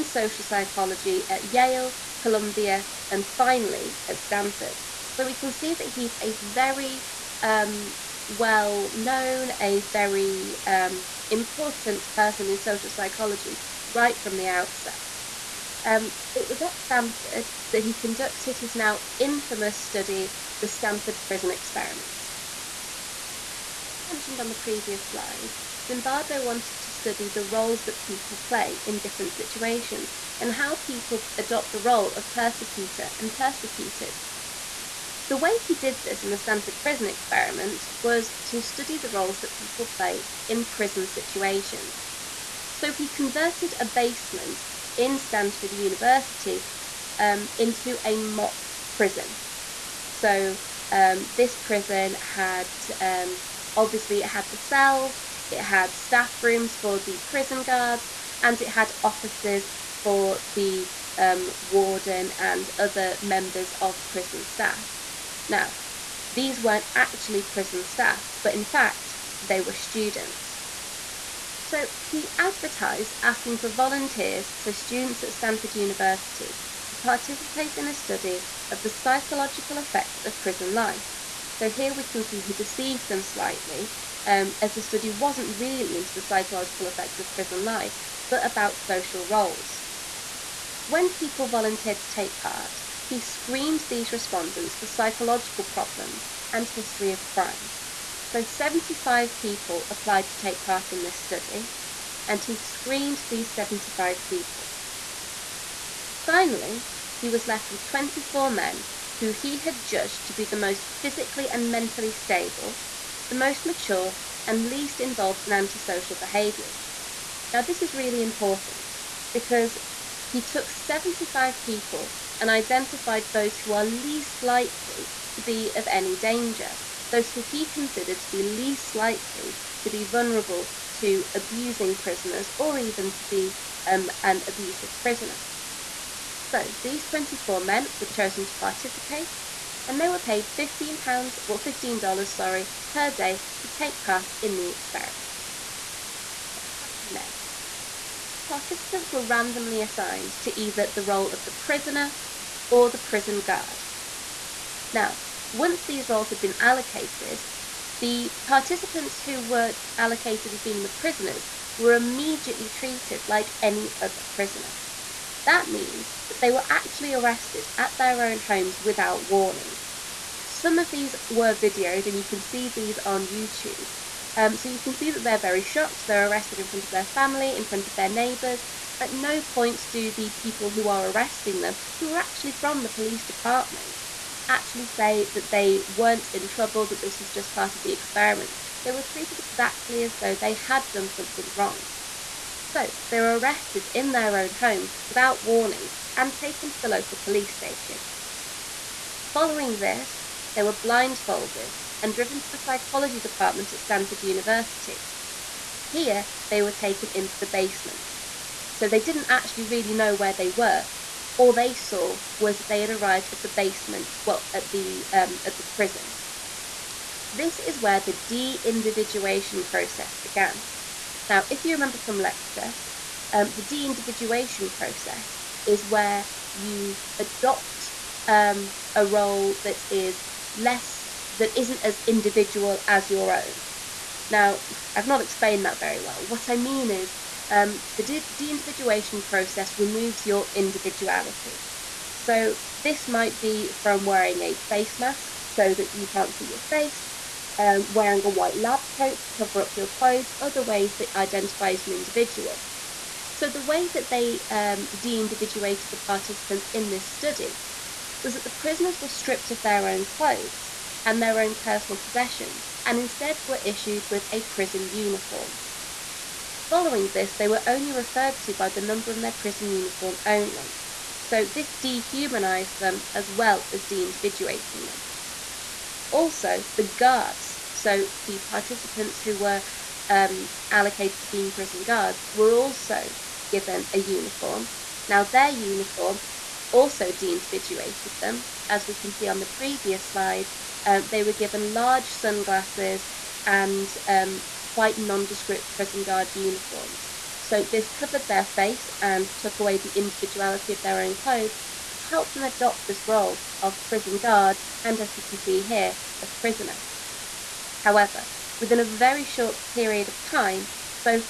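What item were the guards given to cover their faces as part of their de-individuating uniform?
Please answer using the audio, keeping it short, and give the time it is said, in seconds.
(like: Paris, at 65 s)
large sunglasses, at 291 s.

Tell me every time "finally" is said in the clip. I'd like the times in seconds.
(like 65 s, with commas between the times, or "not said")
3 s, 106 s.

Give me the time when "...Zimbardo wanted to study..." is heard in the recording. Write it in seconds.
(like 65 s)
25 s.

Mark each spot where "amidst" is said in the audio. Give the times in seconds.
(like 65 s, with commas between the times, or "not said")
not said.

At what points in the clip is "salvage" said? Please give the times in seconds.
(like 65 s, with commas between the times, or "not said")
not said.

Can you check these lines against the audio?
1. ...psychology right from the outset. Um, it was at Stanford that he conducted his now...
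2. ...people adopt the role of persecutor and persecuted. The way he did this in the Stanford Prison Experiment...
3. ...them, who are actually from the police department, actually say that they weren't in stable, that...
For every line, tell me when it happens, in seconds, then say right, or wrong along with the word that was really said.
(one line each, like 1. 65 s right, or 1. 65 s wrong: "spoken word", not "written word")
1. 12 s right
2. 30 s right
3. 181 s wrong: "trouble", not "stable".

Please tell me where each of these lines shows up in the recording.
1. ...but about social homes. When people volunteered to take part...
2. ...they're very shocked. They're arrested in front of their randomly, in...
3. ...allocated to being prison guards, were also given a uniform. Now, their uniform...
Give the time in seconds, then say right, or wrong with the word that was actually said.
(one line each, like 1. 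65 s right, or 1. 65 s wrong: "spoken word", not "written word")
1. 88 s wrong: "roles", not "homes"
2. 175 s wrong: "family", not "randomly"
3. 280 s right.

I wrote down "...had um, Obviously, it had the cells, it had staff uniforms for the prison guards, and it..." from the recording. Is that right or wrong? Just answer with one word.
wrong.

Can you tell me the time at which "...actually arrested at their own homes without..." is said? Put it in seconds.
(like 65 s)
166 s.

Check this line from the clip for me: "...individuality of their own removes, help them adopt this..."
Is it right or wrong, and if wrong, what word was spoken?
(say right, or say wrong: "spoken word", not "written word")
wrong: "clothes", not "removes".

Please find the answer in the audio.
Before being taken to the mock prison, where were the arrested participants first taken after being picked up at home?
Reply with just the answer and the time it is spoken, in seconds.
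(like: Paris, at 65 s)
local police station, at 196 s.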